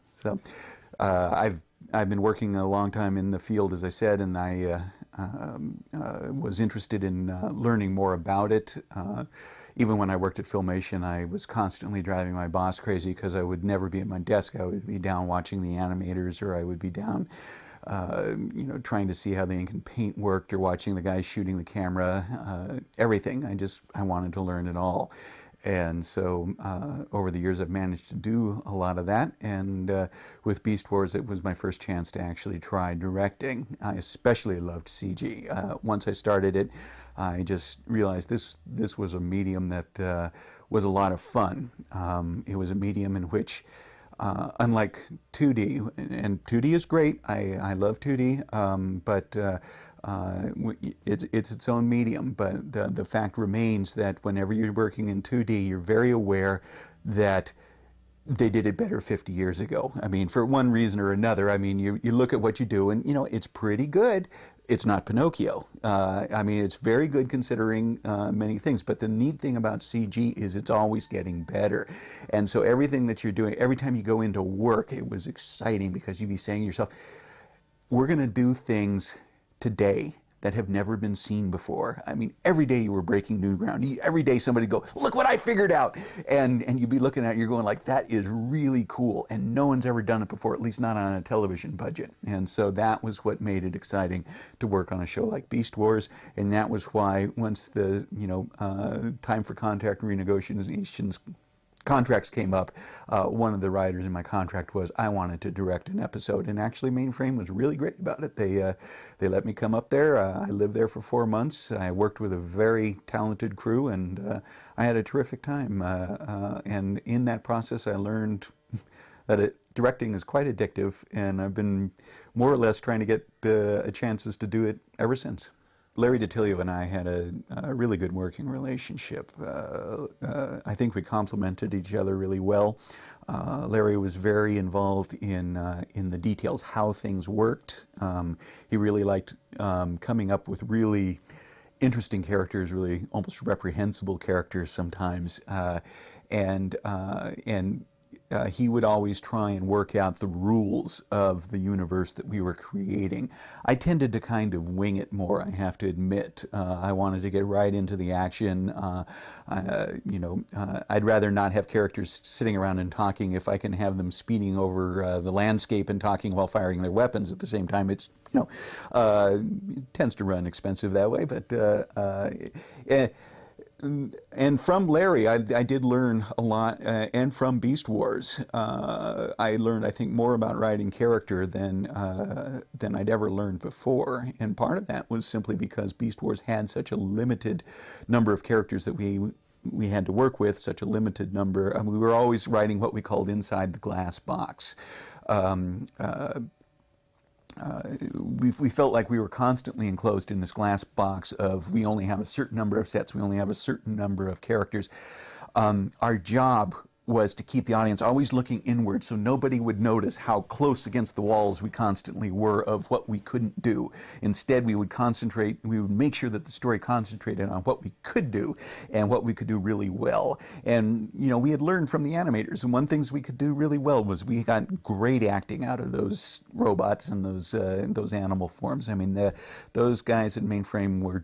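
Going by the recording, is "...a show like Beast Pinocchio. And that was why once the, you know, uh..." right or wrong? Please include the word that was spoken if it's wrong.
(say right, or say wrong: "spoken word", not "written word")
wrong: "Wars", not "Pinocchio".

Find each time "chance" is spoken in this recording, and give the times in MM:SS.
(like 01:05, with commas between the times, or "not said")
00:31, 02:03.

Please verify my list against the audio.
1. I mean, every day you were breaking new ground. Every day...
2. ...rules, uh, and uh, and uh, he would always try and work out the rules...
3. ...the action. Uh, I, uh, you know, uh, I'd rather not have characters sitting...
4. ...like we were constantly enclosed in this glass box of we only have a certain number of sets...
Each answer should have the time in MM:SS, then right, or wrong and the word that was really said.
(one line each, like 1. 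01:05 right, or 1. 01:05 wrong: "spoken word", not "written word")
1. 01:22 right
2. 02:24 wrong: "sometimes", not "rules"
3. 02:37 right
4. 03:18 right.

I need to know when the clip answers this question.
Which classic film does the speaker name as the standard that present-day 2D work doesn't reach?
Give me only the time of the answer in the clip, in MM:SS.
01:05.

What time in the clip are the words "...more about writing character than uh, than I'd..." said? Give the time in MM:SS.
03:00.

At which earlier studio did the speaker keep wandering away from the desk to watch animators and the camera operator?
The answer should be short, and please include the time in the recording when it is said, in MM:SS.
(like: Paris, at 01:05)
Filmation, at 00:10.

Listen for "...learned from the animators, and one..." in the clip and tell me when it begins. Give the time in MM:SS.
03:41.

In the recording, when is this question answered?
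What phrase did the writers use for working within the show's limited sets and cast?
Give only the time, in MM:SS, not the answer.
03:13.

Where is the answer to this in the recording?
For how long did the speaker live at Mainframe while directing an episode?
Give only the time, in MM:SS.
01:50.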